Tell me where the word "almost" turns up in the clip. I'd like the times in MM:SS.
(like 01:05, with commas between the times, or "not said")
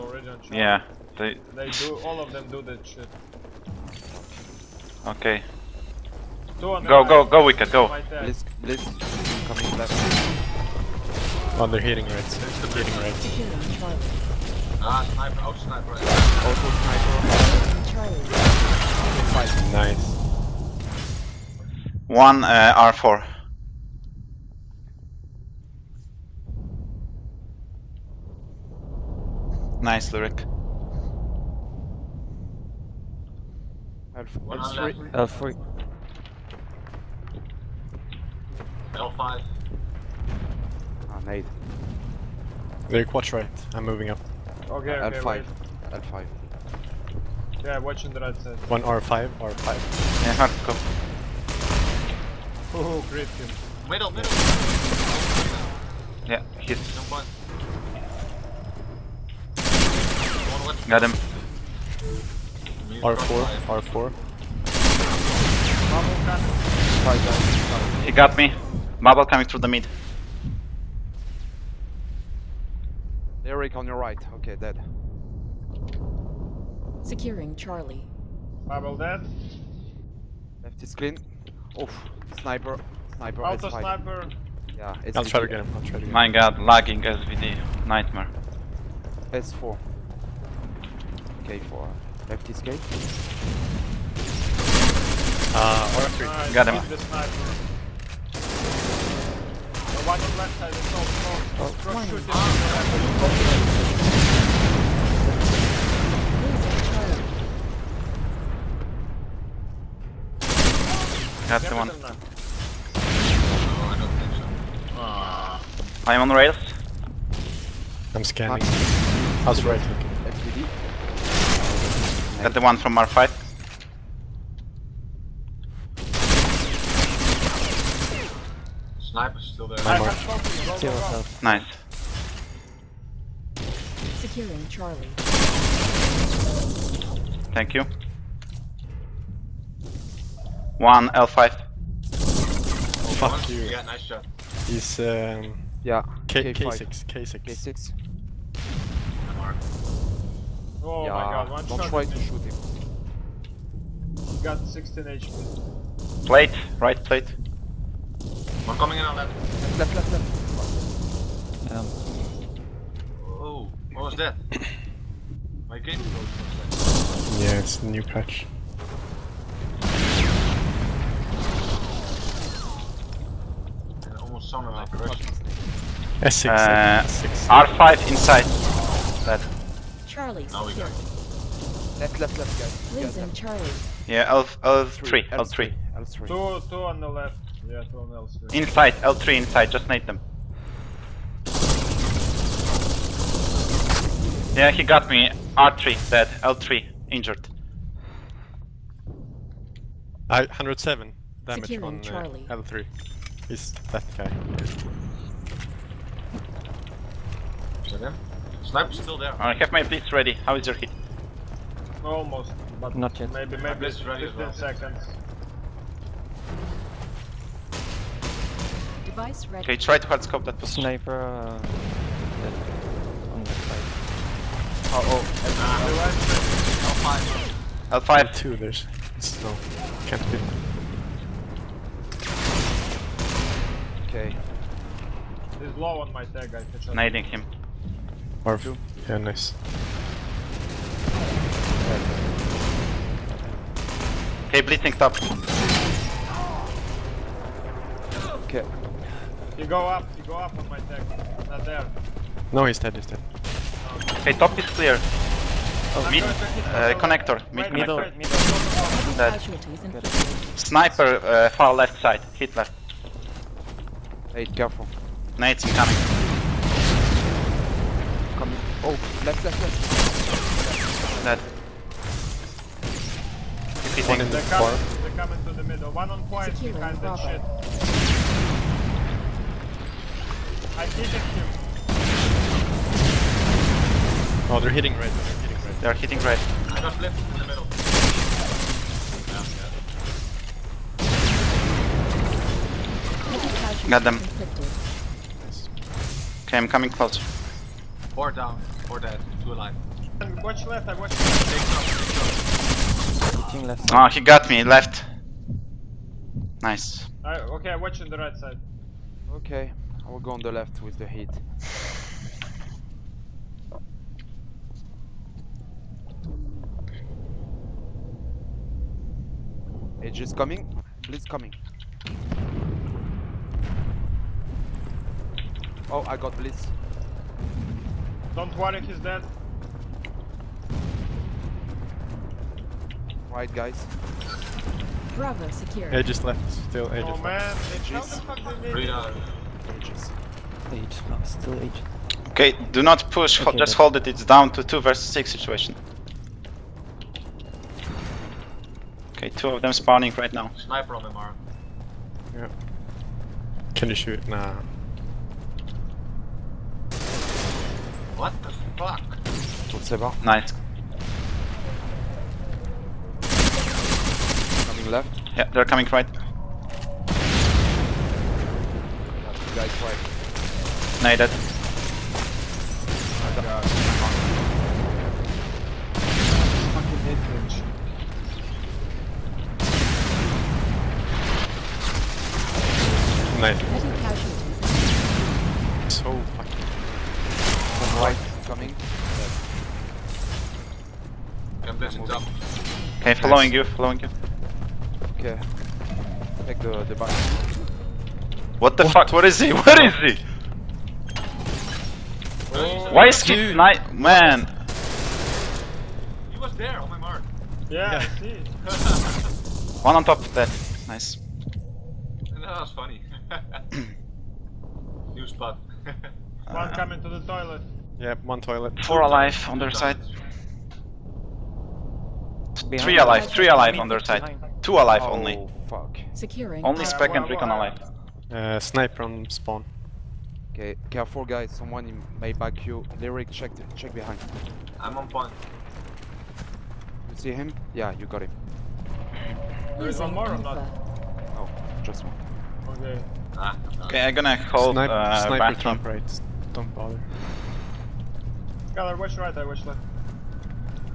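02:54, 03:32.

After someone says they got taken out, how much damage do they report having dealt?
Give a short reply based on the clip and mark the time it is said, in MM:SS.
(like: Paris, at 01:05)
107, at 03:20.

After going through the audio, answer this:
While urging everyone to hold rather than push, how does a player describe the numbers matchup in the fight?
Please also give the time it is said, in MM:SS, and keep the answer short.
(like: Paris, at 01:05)
2 versus 6, at 05:44.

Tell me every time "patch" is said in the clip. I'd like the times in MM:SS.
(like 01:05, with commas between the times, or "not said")
02:48.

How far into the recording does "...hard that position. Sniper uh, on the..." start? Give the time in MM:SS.
03:40.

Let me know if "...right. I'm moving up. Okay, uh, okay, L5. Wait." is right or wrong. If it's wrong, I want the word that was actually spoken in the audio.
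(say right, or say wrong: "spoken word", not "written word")
right.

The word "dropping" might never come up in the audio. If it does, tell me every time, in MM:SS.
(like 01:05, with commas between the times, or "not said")
not said.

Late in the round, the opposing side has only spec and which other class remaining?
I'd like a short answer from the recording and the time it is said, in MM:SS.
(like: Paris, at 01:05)
Recon, at 07:07.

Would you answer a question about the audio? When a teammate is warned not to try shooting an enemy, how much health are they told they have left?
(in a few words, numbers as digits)
16 HP.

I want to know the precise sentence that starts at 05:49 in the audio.
Okay, two of them spawning right now.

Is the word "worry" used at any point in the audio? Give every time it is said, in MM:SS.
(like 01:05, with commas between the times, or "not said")
05:28.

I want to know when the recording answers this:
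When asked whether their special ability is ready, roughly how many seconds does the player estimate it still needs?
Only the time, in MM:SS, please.
03:33.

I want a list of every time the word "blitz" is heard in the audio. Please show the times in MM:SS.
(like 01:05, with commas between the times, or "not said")
03:29, 05:21, 05:26.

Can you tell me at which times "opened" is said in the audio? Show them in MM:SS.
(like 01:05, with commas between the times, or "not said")
not said.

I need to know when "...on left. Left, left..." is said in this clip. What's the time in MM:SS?
02:39.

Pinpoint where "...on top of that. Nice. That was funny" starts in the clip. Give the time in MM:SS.
06:49.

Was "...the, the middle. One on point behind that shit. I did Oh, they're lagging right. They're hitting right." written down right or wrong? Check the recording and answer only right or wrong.
wrong.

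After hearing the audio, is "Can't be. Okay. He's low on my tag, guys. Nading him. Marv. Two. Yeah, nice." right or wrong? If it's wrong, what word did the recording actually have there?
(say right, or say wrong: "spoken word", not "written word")
right.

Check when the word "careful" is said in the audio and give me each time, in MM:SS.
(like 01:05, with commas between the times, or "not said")
04:24, 07:10.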